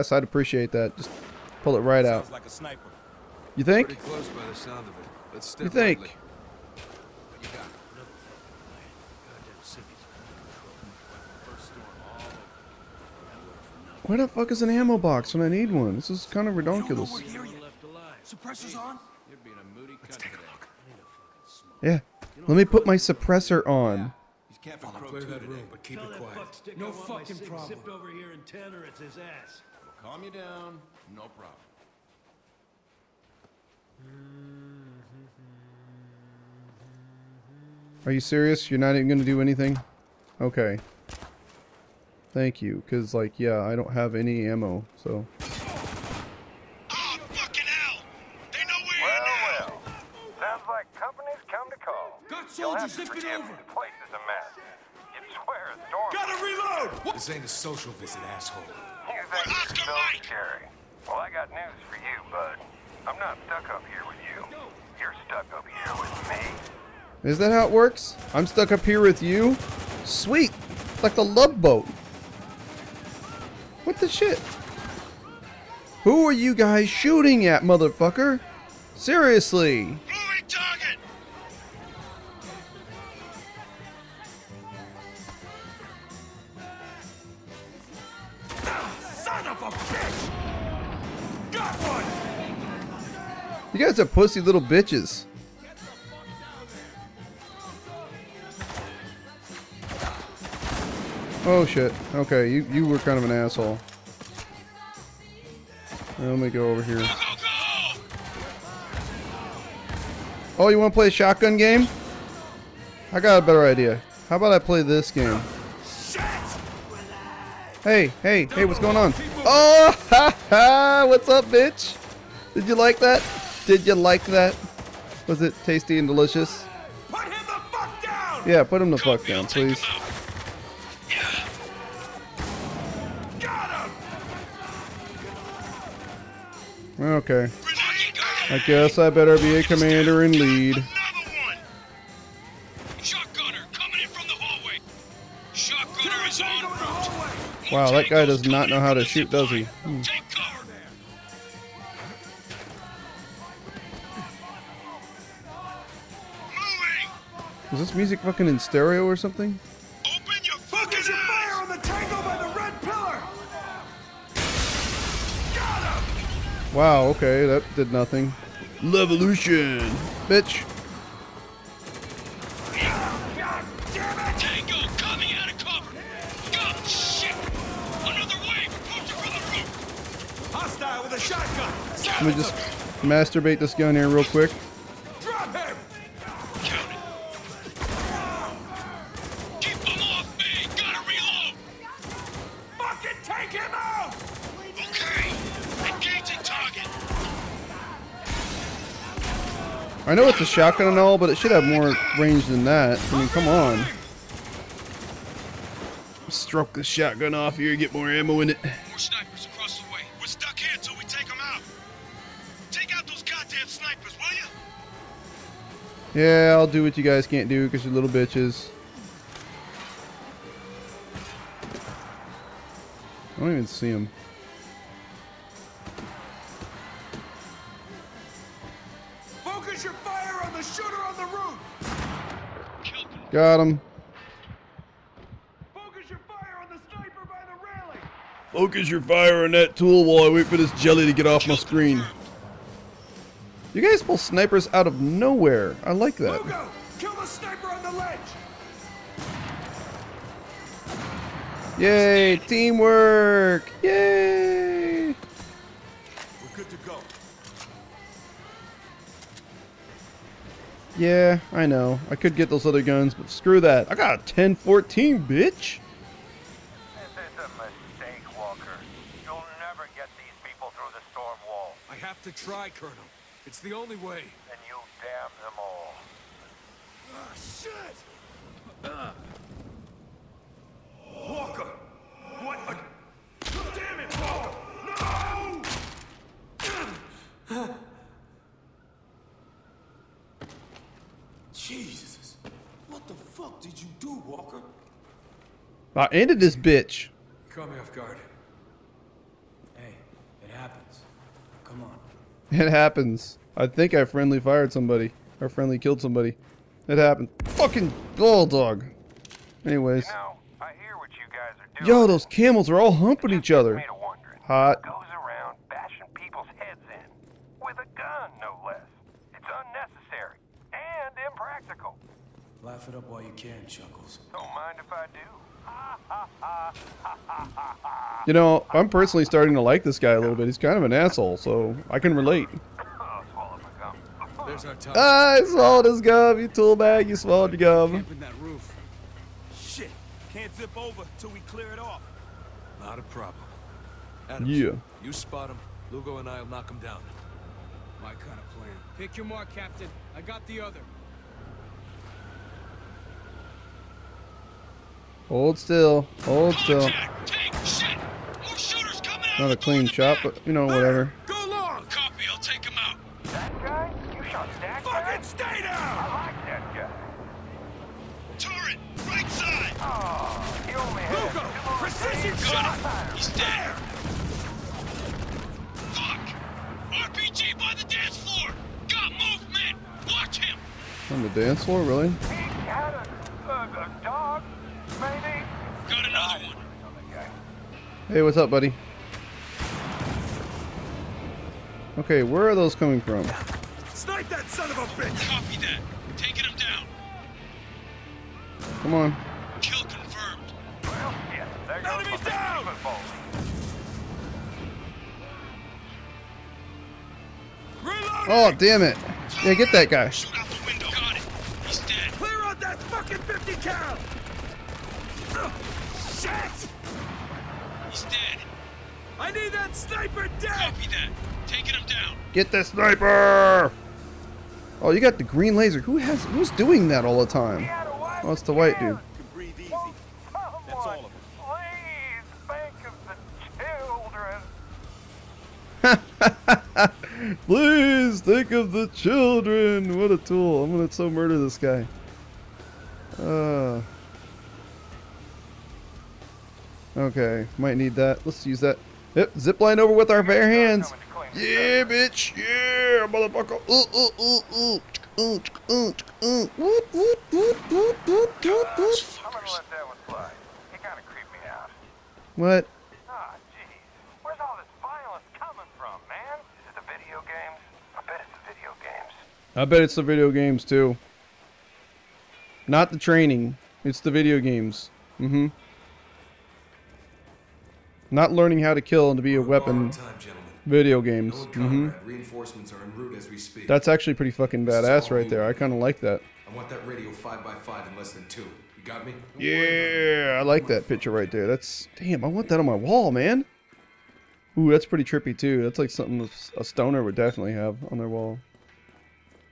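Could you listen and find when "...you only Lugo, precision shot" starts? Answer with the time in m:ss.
6:10.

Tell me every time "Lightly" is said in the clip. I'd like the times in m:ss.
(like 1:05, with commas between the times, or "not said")
0:05.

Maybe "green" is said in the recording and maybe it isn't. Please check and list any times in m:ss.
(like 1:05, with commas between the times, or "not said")
7:05.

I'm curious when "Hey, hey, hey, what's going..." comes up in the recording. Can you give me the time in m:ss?
1:57.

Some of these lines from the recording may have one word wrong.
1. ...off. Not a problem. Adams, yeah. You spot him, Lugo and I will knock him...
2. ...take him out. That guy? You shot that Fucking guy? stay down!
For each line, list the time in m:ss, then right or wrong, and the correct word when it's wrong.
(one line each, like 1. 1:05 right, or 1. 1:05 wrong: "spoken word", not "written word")
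1. 5:41 right
2. 6:02 right.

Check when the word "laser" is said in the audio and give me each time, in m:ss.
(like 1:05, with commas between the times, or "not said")
7:05.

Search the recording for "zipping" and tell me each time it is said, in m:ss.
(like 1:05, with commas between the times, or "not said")
0:52.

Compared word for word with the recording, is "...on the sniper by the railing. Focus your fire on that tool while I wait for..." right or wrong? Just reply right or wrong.
right.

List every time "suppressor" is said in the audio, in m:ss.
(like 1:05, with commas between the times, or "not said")
0:18, 0:22.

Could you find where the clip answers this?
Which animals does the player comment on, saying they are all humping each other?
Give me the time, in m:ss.
5:12.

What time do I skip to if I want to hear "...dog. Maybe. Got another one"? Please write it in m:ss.
6:24.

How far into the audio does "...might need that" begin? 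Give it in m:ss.
7:27.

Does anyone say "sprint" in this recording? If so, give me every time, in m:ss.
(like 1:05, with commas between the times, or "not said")
not said.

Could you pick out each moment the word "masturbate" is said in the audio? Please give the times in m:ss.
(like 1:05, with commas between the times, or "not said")
3:03.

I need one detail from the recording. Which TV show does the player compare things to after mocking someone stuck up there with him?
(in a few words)
The Love Boat.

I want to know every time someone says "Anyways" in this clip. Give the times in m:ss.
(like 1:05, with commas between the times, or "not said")
5:09.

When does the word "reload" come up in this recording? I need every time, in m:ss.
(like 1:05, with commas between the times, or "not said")
0:56.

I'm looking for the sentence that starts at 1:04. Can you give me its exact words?
You're stuck up here with me.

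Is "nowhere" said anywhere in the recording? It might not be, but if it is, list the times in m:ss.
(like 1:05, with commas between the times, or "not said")
4:05.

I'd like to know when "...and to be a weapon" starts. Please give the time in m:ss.
7:59.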